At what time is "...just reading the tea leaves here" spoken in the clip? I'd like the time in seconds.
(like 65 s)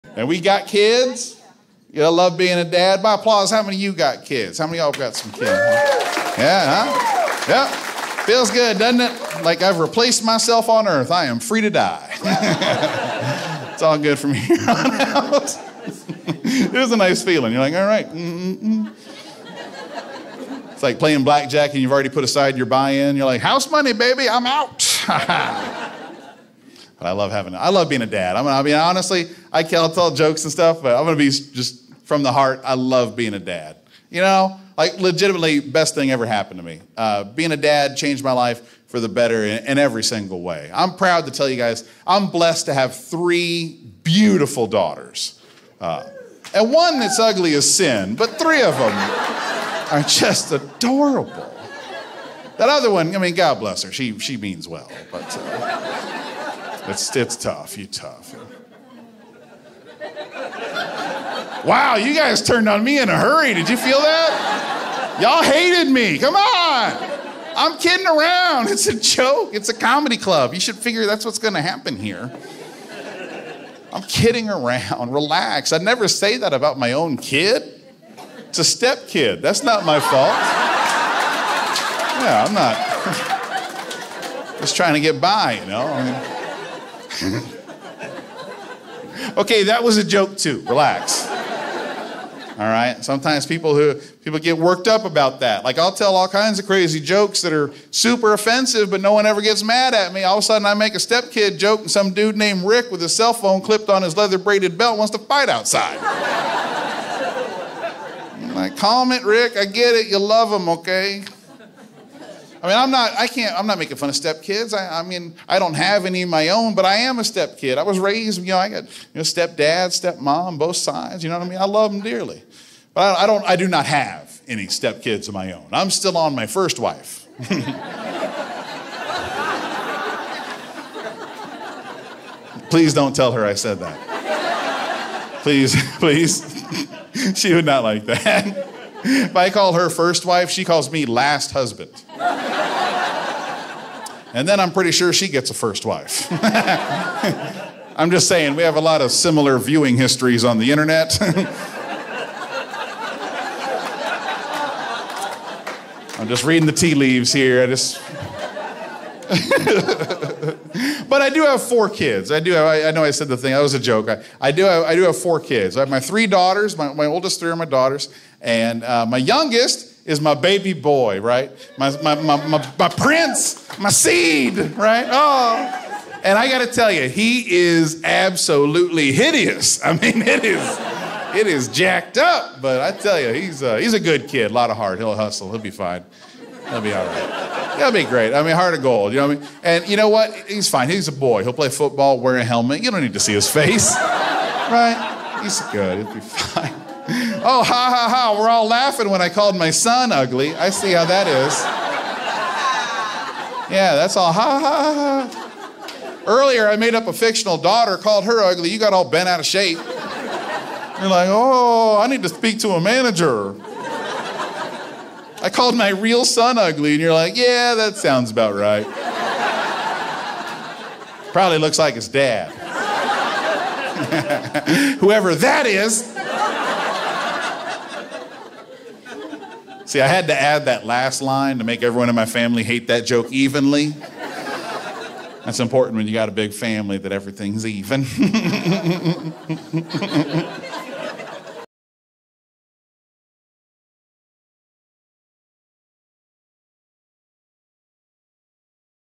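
156 s.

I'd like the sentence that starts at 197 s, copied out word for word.
Oh, ha ha ha, we're all laughing when I called my son ugly.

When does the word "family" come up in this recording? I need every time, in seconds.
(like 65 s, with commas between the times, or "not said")
232 s, 236 s.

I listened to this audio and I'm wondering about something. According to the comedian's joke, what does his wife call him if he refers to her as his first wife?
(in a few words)
Last husband.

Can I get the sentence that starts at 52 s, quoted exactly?
That other one, I mean, God bless her, she, she means well.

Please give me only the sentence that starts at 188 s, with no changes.
I mean, heart of gold, you know what I mean?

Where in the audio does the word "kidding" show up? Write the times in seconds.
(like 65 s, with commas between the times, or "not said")
67 s, 74 s.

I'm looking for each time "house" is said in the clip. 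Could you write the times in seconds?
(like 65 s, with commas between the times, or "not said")
23 s.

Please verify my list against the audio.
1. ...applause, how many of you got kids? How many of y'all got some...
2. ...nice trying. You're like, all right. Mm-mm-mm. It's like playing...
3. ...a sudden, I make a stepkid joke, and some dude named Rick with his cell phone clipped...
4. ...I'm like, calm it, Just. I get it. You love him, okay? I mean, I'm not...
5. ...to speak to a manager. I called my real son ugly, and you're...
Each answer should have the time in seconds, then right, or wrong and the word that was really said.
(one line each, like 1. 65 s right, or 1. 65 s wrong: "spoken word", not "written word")
1. 3 s right
2. 16 s wrong: "feeling", not "trying"
3. 100 s right
4. 108 s wrong: "Rick", not "Just"
5. 212 s right.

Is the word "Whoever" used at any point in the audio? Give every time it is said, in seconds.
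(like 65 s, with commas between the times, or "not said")
224 s.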